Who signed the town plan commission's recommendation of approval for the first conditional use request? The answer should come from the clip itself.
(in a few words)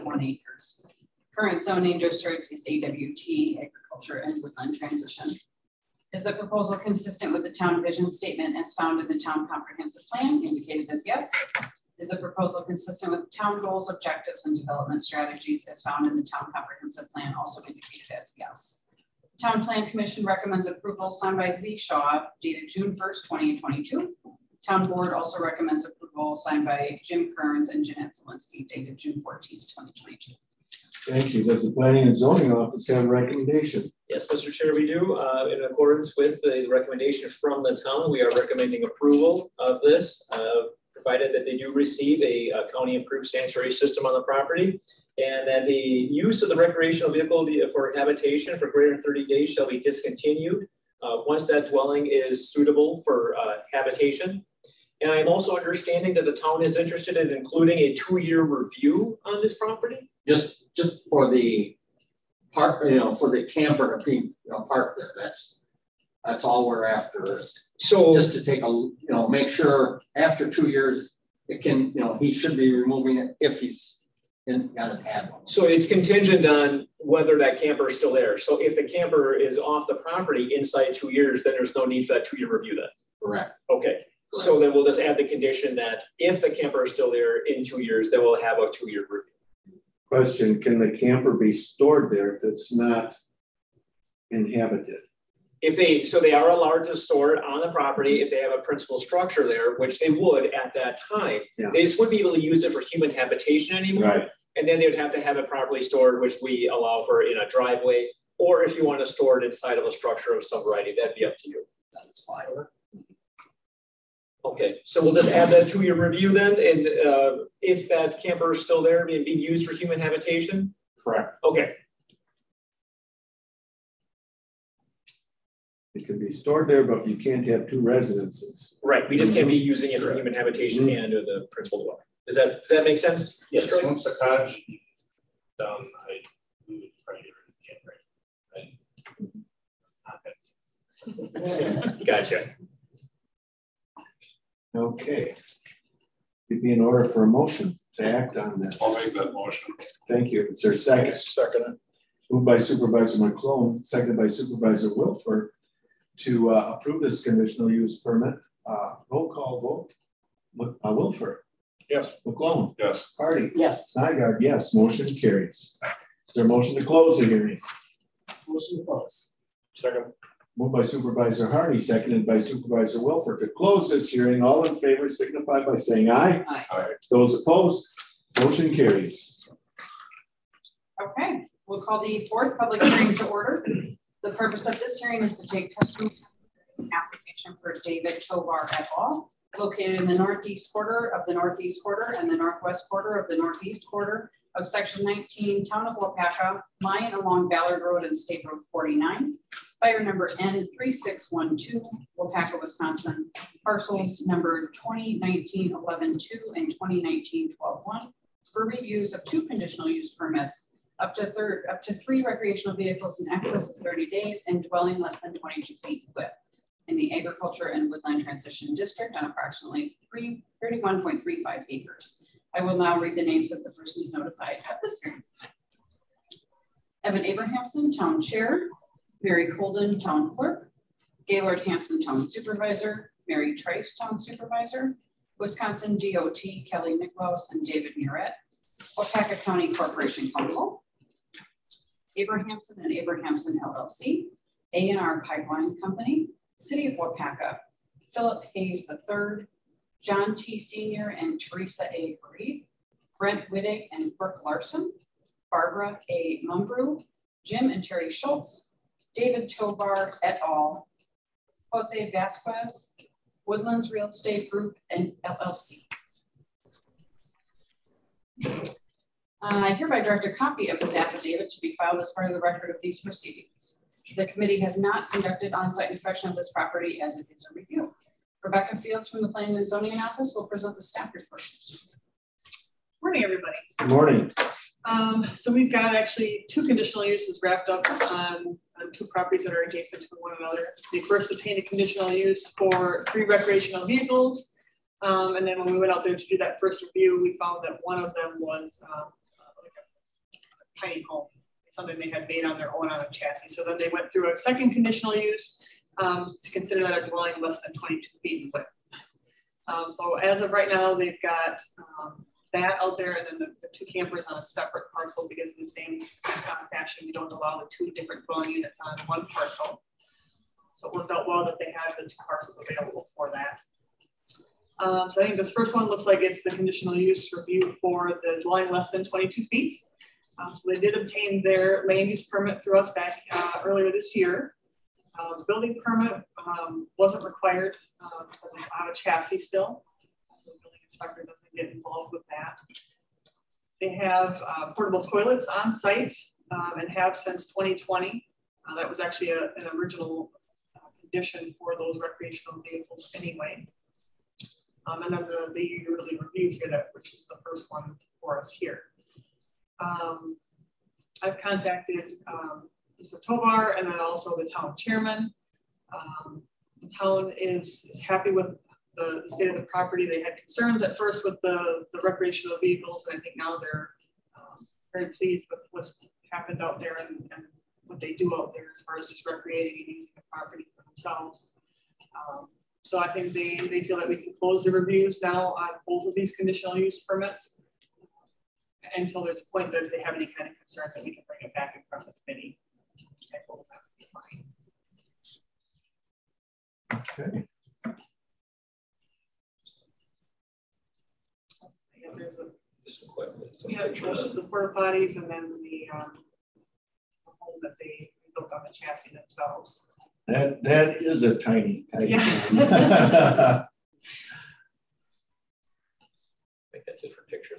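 Lee Shaw.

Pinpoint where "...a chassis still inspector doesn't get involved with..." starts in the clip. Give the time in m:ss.
5:38.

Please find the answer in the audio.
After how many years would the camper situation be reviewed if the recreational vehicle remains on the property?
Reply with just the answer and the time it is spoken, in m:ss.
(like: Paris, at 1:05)
2, at 0:57.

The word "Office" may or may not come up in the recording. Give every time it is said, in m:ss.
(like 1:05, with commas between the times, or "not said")
0:32, 4:39.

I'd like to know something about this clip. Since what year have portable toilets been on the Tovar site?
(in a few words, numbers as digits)
2020.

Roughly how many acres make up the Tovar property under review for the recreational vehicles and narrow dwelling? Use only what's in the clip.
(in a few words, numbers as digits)
31.35.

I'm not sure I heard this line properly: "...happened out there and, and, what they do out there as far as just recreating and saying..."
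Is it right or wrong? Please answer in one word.
wrong.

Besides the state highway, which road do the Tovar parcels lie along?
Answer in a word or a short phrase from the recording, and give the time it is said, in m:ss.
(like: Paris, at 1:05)
Ballard Road, at 3:17.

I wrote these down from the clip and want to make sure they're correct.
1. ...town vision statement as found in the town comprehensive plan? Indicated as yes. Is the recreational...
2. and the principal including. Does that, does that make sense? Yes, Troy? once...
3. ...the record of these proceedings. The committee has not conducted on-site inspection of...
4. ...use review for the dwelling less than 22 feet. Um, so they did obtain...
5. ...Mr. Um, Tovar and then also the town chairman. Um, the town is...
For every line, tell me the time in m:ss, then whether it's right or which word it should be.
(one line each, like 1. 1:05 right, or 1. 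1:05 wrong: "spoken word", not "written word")
1. 0:07 wrong: "proposal", not "recreational"
2. 2:11 wrong: "dwelling", not "including"
3. 4:32 right
4. 5:26 right
5. 6:02 right.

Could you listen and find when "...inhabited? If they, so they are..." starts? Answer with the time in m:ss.
1:34.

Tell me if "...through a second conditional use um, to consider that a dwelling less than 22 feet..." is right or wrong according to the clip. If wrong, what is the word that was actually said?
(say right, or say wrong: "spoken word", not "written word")
right.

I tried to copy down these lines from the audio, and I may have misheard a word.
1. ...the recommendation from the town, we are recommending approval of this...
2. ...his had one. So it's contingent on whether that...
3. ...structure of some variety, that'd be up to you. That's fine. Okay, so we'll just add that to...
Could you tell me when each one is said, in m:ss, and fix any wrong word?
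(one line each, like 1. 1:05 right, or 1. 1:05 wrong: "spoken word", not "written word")
1. 0:36 right
2. 1:14 right
3. 1:49 right.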